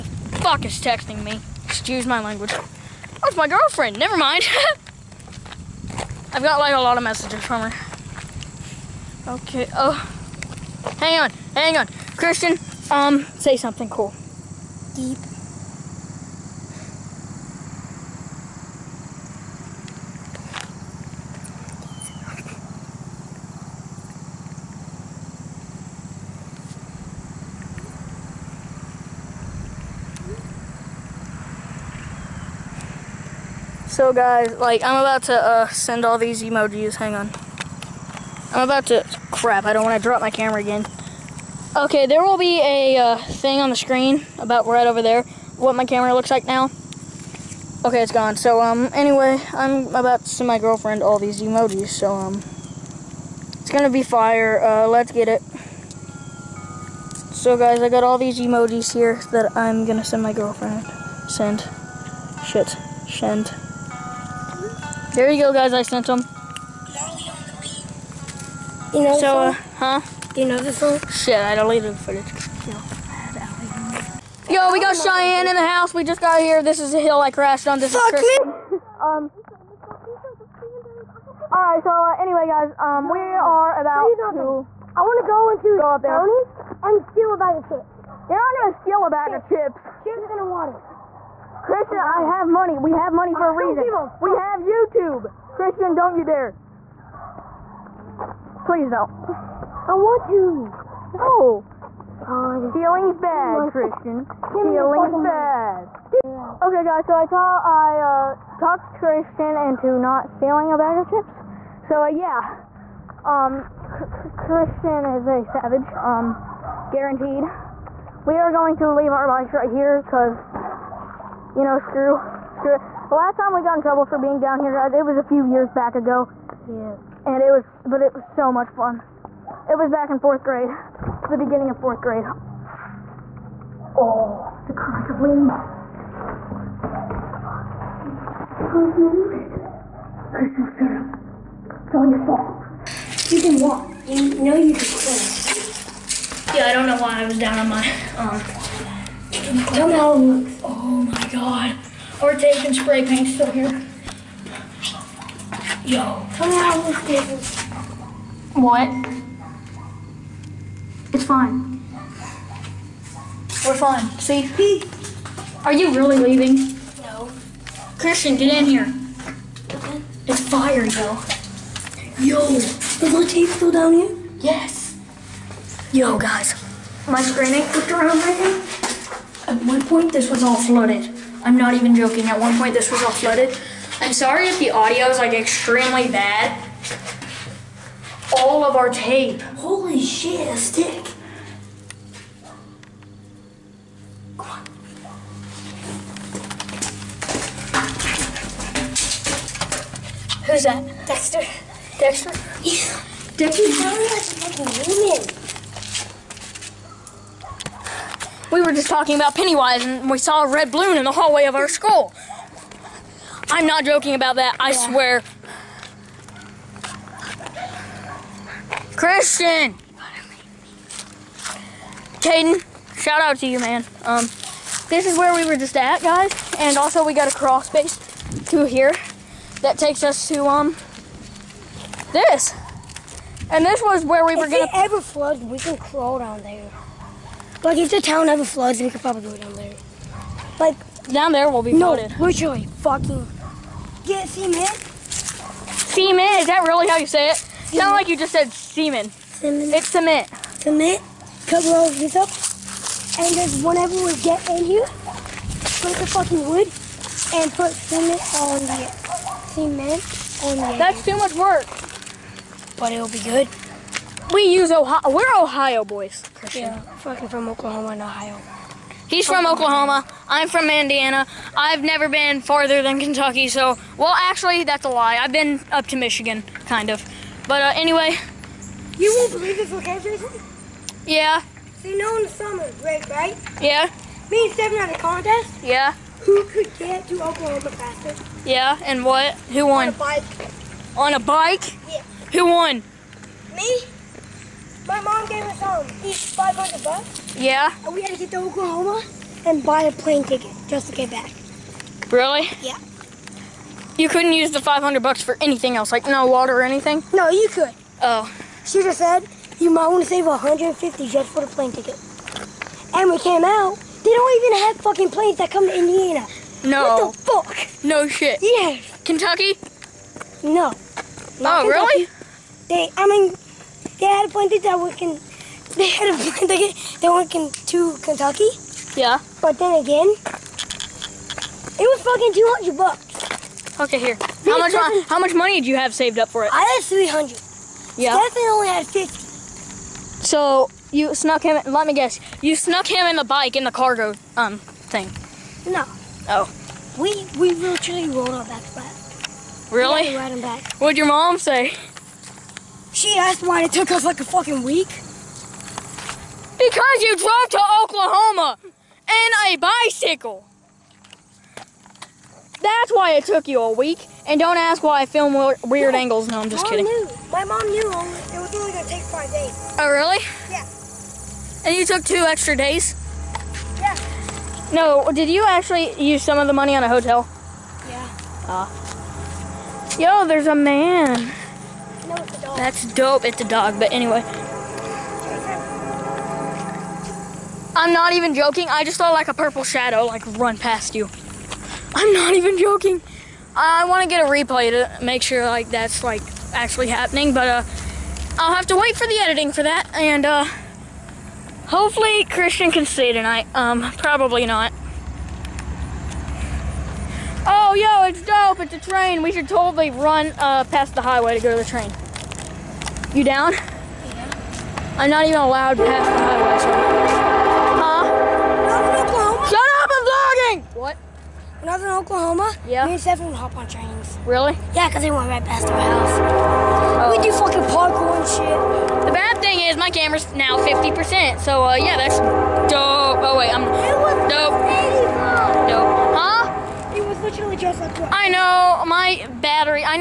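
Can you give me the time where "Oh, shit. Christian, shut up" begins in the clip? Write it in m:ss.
2:18.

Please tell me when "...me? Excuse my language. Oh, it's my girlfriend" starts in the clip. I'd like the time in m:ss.
0:01.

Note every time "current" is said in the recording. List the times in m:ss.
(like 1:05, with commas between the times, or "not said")
2:14.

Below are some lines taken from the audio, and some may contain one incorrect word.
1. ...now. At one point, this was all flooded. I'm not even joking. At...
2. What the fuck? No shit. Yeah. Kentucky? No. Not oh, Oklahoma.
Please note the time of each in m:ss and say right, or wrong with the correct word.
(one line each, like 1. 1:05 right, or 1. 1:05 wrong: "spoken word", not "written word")
1. 2:58 right
2. 5:17 wrong: "Kentucky", not "Oklahoma".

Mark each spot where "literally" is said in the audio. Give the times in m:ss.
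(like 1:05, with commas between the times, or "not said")
4:02, 5:47.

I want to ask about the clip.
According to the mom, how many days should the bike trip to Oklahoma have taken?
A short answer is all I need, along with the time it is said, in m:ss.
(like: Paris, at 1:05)
5, at 6:09.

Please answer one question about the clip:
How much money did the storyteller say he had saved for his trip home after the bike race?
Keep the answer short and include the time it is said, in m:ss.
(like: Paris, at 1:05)
$300, at 5:36.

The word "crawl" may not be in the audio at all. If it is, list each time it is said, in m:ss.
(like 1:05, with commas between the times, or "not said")
3:47, 3:55.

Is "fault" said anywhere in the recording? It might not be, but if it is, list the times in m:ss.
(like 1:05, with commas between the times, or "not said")
2:22.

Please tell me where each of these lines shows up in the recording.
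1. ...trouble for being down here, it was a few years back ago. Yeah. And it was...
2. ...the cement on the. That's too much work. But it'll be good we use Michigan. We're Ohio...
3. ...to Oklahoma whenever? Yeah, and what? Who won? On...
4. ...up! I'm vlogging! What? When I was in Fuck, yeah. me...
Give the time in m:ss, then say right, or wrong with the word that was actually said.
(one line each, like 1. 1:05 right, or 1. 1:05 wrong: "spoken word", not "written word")
1. 2:03 right
2. 4:18 wrong: "Ohio", not "Michigan"
3. 4:47 wrong: "faster", not "whenever"
4. 6:59 wrong: "Oklahoma", not "Fuck".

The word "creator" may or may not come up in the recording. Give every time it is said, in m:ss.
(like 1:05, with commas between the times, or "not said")
not said.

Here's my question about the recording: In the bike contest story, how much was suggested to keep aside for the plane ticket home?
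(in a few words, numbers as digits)
$150.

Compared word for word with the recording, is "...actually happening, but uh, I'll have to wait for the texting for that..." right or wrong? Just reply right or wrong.
wrong.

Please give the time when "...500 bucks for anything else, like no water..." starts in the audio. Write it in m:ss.
5:04.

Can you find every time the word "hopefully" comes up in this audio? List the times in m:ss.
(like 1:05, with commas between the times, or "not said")
6:41.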